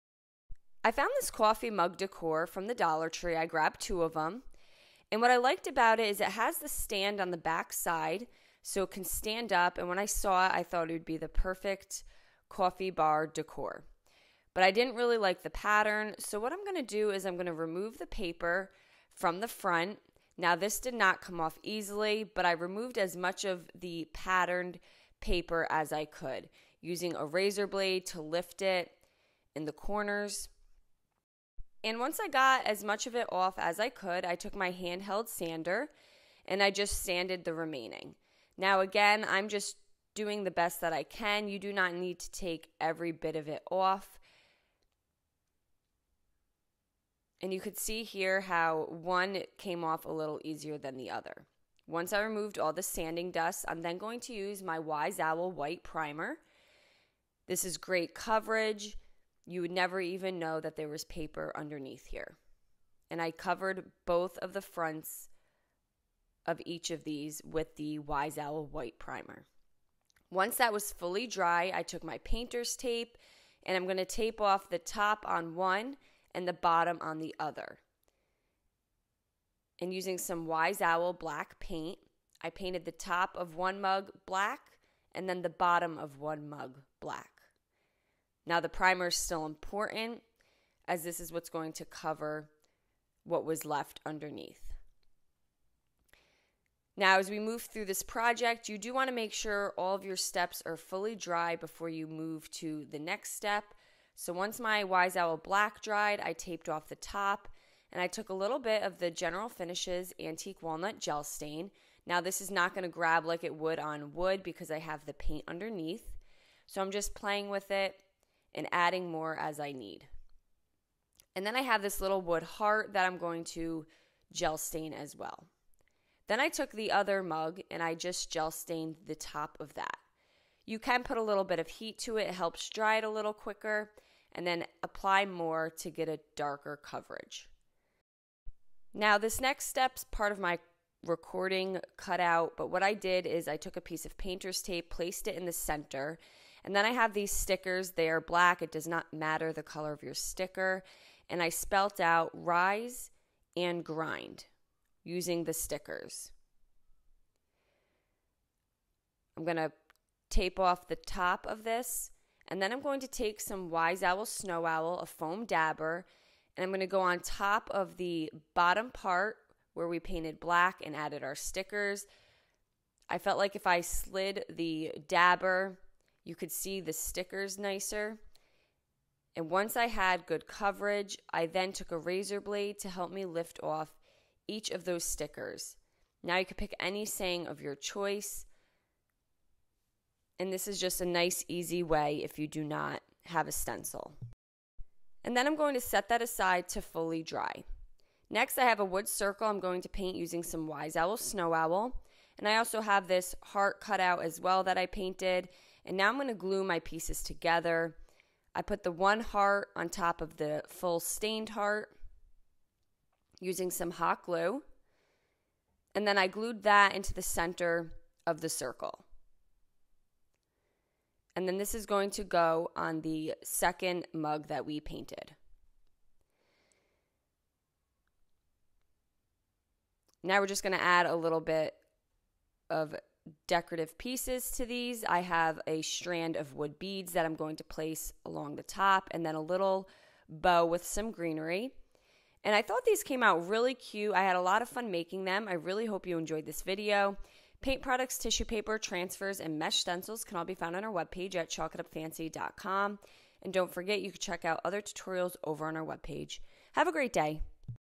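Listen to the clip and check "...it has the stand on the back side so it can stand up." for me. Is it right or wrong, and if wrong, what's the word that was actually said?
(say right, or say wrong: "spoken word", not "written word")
right.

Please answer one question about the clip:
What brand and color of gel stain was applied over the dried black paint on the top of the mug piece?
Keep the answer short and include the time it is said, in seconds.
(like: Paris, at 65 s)
General Finishes Antique Walnut, at 109 s.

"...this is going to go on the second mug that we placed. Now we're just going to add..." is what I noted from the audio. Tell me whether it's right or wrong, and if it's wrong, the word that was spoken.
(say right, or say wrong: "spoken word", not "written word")
wrong: "painted", not "placed".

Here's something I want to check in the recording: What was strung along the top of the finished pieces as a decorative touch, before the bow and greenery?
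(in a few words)
Wood beads.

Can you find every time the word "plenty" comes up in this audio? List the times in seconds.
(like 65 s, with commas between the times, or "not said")
not said.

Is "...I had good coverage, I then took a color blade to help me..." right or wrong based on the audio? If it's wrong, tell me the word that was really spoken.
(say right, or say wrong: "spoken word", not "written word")
wrong: "razor", not "color".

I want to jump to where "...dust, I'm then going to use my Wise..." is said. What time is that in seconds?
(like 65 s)
53 s.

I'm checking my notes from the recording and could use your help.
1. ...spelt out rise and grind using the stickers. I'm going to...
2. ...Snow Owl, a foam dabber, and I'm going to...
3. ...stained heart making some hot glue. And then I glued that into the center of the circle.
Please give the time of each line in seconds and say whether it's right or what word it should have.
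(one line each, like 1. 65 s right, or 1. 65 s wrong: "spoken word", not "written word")
1. 151 s right
2. 164 s right
3. 210 s wrong: "using", not "making".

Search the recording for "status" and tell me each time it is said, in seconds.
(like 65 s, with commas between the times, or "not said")
not said.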